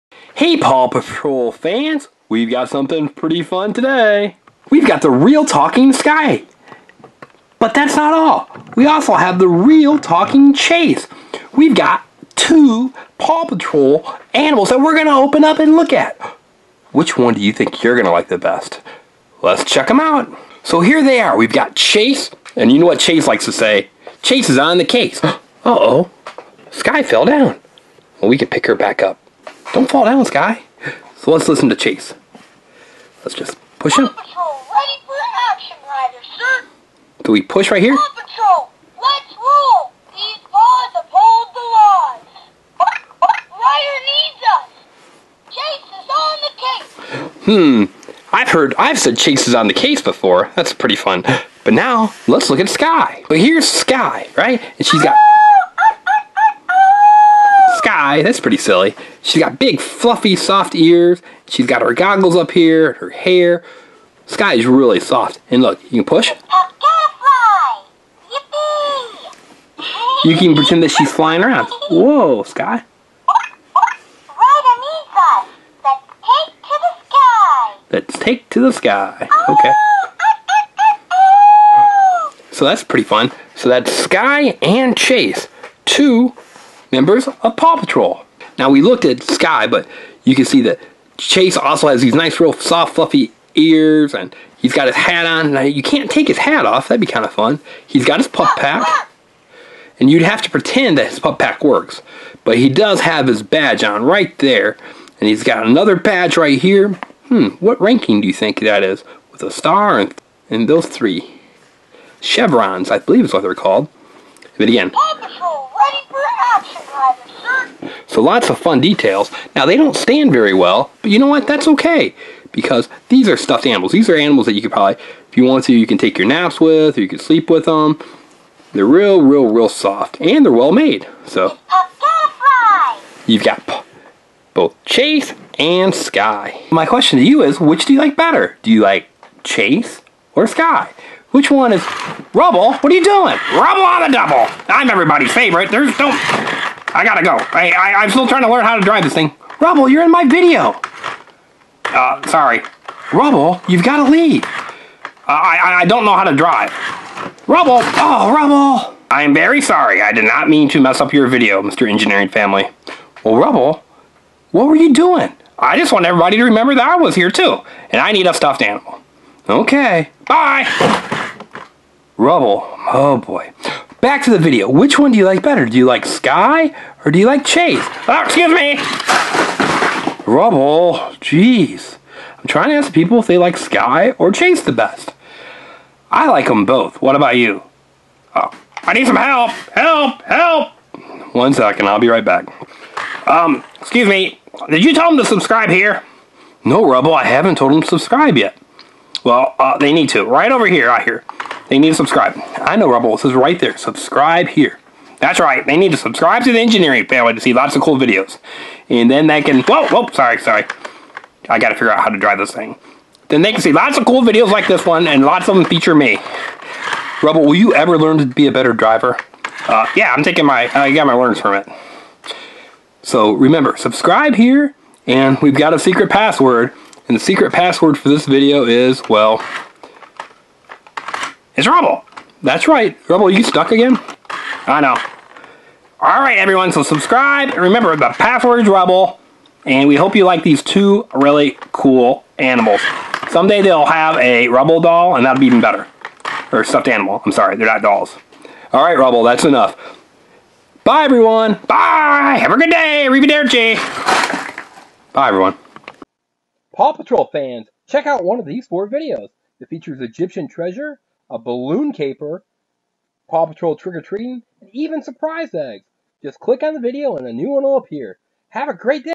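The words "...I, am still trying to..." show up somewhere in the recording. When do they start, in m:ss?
2:27.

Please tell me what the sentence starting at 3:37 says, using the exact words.
Rubble, will you ever learn to be a better driver?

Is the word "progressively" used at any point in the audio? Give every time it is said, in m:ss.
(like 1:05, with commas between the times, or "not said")
not said.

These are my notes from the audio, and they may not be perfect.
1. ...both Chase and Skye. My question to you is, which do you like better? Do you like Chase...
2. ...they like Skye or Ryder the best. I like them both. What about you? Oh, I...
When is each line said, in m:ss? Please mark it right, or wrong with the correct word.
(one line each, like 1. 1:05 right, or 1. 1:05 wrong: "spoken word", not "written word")
1. 2:14 right
2. 3:03 wrong: "Chase", not "Ryder".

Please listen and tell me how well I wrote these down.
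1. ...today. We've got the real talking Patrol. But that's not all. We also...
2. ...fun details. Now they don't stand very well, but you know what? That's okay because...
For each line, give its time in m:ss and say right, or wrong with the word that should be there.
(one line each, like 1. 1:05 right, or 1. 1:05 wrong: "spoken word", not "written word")
1. 0:03 wrong: "Skye", not "Patrol"
2. 1:58 right.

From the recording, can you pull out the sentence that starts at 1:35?
Now you can't take his hat off, that'd be kind of fun.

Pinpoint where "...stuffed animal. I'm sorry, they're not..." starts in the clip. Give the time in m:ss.
4:06.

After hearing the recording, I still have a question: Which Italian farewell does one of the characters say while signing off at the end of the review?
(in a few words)
Arrivederci.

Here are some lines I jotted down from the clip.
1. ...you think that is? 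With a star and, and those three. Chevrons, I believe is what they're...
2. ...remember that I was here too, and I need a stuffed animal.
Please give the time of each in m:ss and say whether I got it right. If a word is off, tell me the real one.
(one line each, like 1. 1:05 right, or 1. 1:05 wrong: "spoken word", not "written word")
1. 1:48 right
2. 2:46 right.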